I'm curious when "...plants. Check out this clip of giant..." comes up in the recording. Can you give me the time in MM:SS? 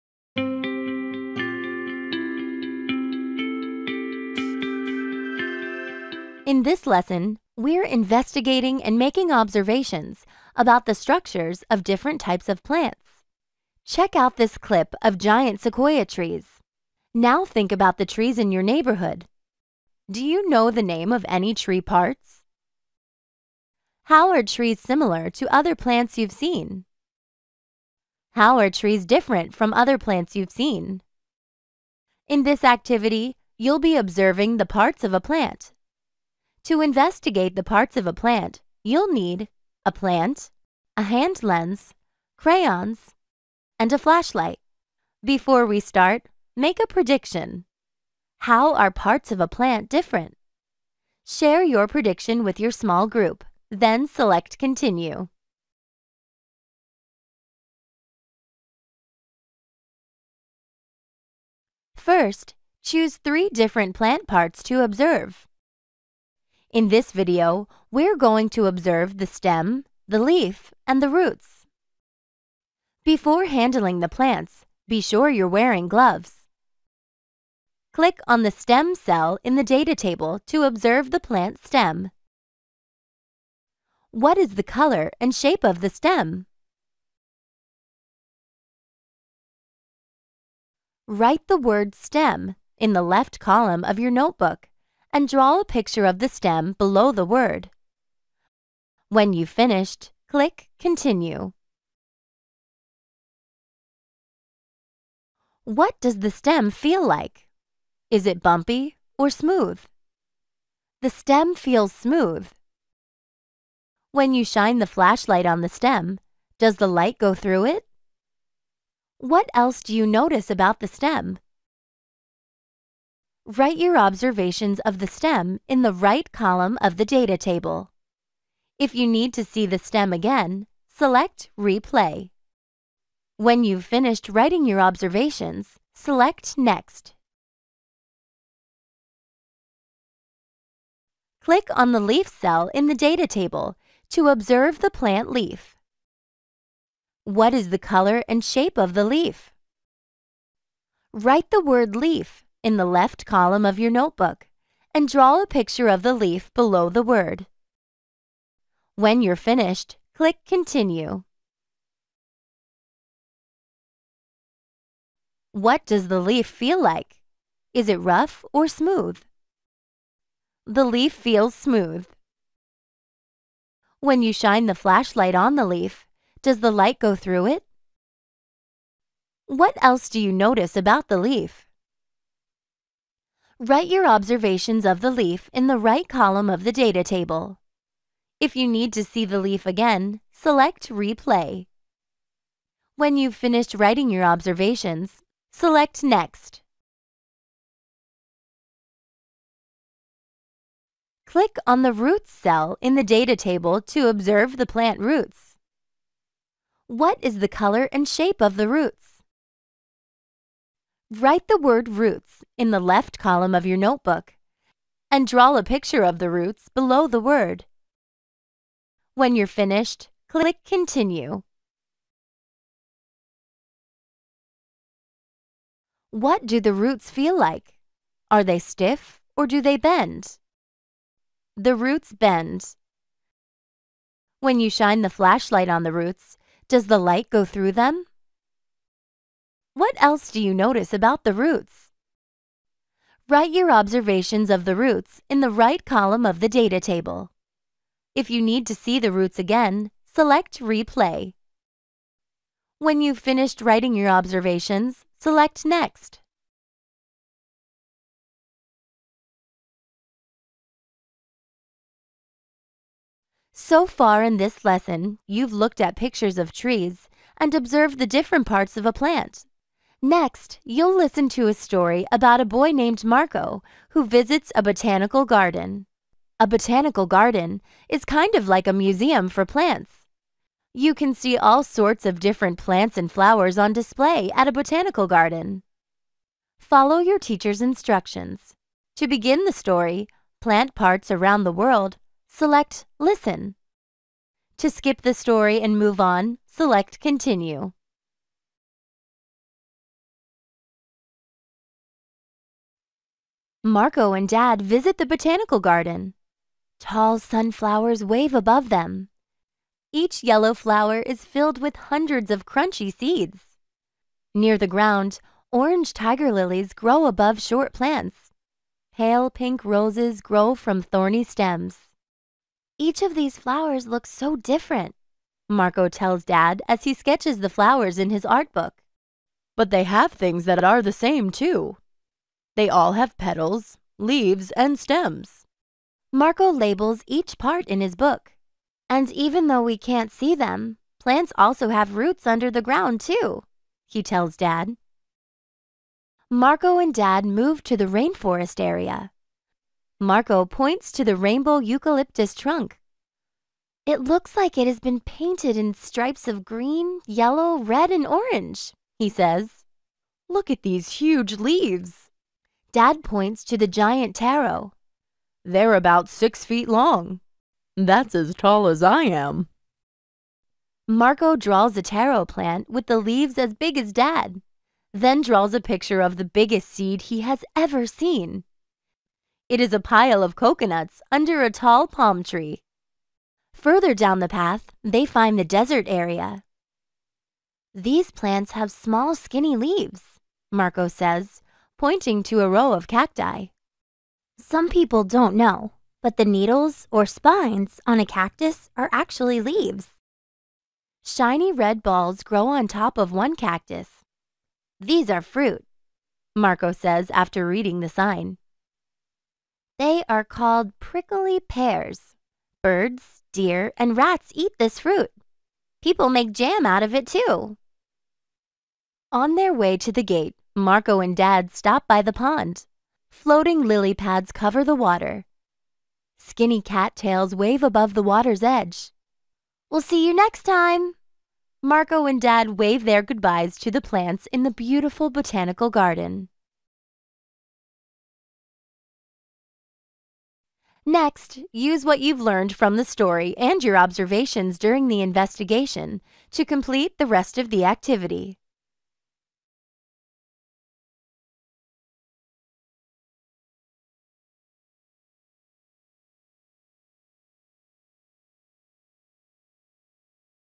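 00:12.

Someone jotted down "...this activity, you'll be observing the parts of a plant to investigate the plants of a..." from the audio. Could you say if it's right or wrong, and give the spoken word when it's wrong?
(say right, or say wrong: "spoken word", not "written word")
wrong: "parts", not "plants".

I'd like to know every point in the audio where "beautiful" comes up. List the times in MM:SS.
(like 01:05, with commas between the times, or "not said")
07:14.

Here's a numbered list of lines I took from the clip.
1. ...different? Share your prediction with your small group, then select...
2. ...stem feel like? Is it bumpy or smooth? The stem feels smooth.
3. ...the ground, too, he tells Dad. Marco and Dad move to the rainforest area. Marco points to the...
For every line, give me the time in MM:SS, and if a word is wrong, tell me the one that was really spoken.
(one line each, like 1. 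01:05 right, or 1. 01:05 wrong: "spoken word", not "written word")
1. 00:49 right
2. 01:46 right
3. 05:42 right.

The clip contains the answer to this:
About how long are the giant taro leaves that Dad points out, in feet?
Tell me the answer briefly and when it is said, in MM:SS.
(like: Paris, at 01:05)
6 feet, at 06:06.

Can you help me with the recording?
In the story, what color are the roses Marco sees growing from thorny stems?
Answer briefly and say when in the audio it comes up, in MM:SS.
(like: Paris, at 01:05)
pale pink, at 05:18.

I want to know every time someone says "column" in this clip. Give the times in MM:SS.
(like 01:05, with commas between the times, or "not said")
01:33, 02:06, 02:33, 03:06, 03:33, 04:05.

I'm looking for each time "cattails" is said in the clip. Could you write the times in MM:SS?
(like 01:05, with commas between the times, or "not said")
07:06.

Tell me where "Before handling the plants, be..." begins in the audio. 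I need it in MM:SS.
01:13.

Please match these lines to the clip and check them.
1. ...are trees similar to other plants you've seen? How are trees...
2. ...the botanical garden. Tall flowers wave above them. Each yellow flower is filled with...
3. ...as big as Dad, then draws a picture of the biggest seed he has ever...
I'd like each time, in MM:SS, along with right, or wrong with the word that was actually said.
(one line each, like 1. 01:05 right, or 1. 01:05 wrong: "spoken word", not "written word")
1. 00:24 right
2. 05:04 wrong: "sunflowers", not "flowers"
3. 06:13 right.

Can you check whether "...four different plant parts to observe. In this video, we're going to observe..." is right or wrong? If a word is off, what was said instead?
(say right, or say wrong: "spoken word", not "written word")
wrong: "three", not "four".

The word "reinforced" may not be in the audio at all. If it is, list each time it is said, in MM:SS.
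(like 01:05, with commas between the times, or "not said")
not said.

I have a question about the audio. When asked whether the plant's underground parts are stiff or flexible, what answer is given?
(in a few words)
They bend.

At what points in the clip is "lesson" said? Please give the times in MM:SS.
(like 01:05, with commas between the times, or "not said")
00:06, 04:24.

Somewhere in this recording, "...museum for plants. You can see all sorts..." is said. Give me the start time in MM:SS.
04:38.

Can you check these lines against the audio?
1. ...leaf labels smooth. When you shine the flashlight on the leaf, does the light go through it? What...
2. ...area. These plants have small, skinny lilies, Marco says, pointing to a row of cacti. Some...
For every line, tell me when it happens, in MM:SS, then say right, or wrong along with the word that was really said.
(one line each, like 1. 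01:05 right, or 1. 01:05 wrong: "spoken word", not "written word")
1. 02:50 wrong: "feels", not "labels"
2. 06:25 wrong: "leaves", not "lilies".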